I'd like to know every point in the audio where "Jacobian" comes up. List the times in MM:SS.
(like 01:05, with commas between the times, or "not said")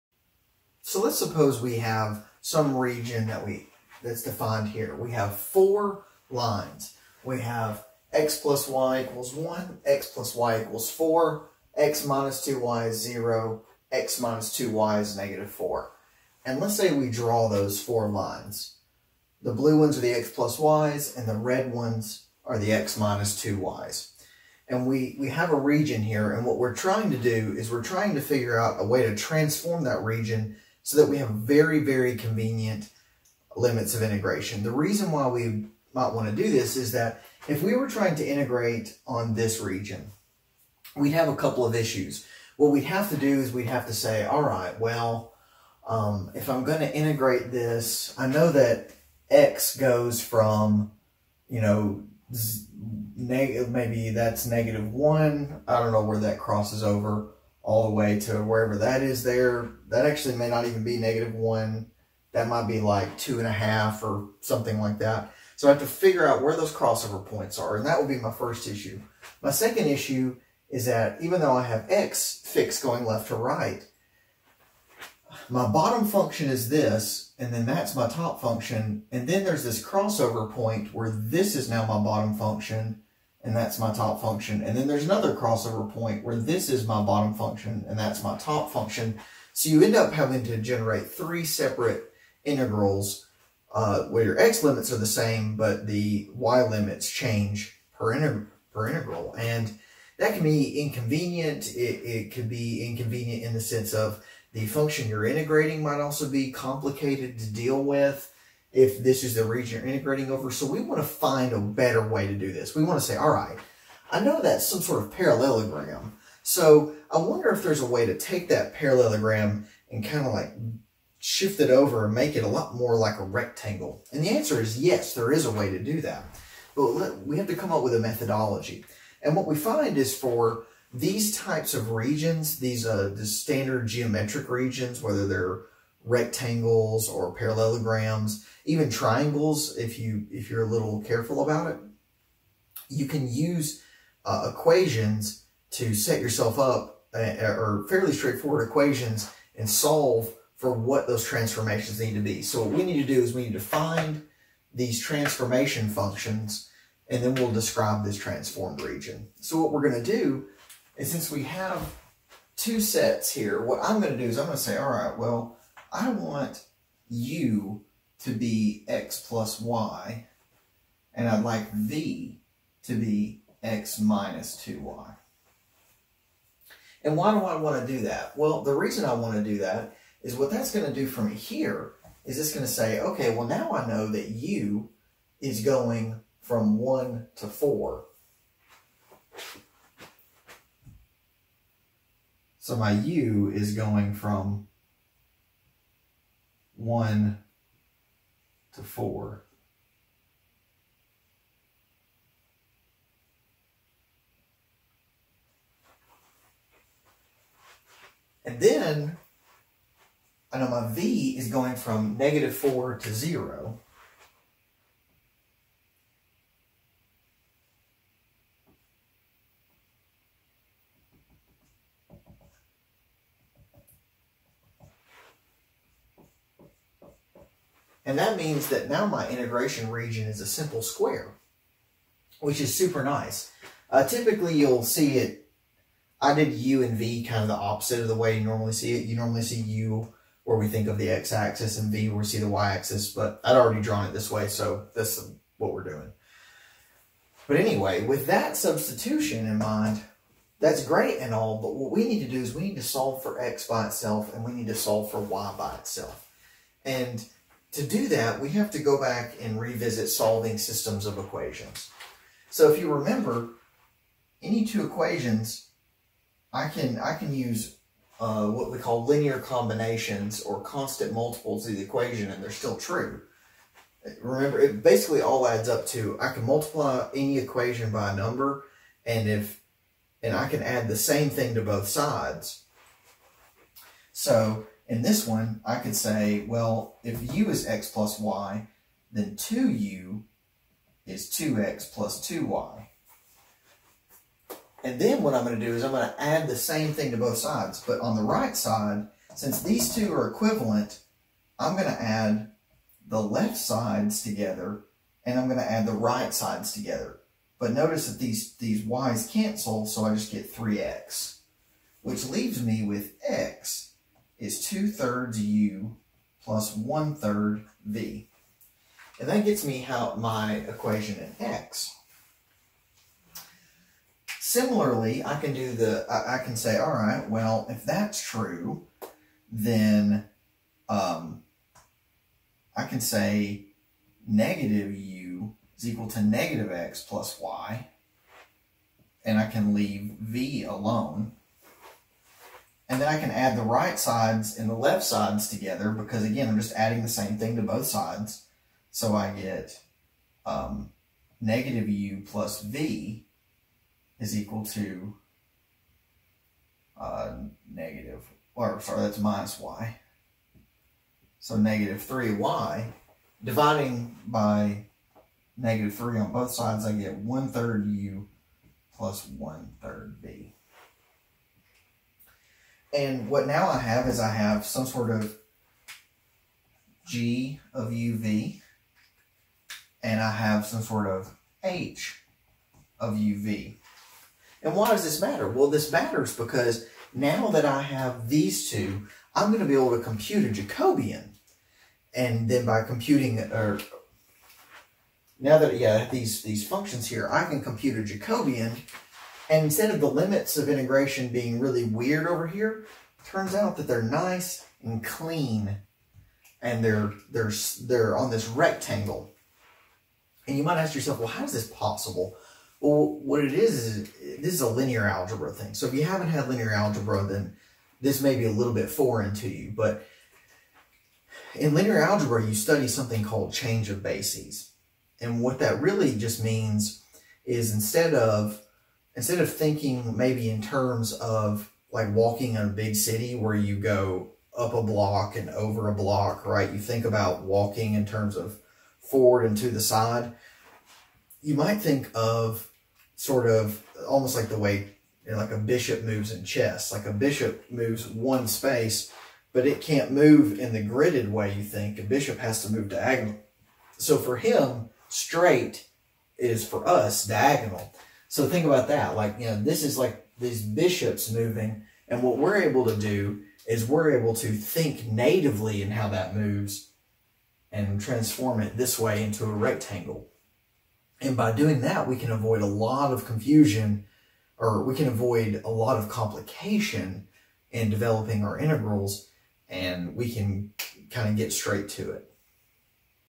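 06:30, 06:38.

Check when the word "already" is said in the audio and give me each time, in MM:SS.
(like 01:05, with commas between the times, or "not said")
04:03.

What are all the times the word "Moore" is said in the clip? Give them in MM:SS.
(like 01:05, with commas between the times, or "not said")
not said.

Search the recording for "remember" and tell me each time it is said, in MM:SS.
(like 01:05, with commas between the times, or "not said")
04:22, 04:34.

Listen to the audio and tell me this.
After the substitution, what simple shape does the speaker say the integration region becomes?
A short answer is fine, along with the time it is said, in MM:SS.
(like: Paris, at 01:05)
square, at 03:50.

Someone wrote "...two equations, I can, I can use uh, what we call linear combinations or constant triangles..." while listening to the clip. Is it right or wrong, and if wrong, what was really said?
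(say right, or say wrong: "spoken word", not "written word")
wrong: "multiples", not "triangles".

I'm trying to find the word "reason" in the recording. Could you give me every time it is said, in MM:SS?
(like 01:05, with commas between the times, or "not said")
00:34, 02:58.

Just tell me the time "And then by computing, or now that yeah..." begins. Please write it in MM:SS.
06:32.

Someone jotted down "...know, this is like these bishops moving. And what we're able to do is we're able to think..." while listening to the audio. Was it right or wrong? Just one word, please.
right.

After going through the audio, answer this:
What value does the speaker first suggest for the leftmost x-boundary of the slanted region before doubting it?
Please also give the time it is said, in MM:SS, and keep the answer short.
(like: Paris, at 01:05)
-1, at 00:54.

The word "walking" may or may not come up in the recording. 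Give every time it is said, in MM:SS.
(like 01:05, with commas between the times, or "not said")
07:12, 07:17.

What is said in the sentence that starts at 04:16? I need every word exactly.
And to do that, we have to go back and revisit solving systems of equations.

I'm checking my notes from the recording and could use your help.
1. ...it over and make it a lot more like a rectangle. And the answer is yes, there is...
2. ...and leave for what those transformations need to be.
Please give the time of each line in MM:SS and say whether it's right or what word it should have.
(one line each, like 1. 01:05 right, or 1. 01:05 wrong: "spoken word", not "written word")
1. 02:01 right
2. 02:29 wrong: "solve", not "leave".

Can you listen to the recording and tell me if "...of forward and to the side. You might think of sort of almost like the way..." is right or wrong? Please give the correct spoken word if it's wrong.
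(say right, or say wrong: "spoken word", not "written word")
right.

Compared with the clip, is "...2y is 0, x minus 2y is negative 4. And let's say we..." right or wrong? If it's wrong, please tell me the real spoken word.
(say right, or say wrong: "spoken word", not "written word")
right.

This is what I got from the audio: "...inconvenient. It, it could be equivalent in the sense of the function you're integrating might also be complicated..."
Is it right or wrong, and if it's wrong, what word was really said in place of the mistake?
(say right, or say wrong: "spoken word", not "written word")
wrong: "inconvenient", not "equivalent".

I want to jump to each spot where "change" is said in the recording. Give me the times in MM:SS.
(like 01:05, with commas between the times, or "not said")
01:37, 07:03.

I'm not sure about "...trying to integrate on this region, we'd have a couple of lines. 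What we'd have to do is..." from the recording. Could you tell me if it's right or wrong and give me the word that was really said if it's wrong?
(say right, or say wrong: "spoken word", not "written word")
wrong: "issues", not "lines".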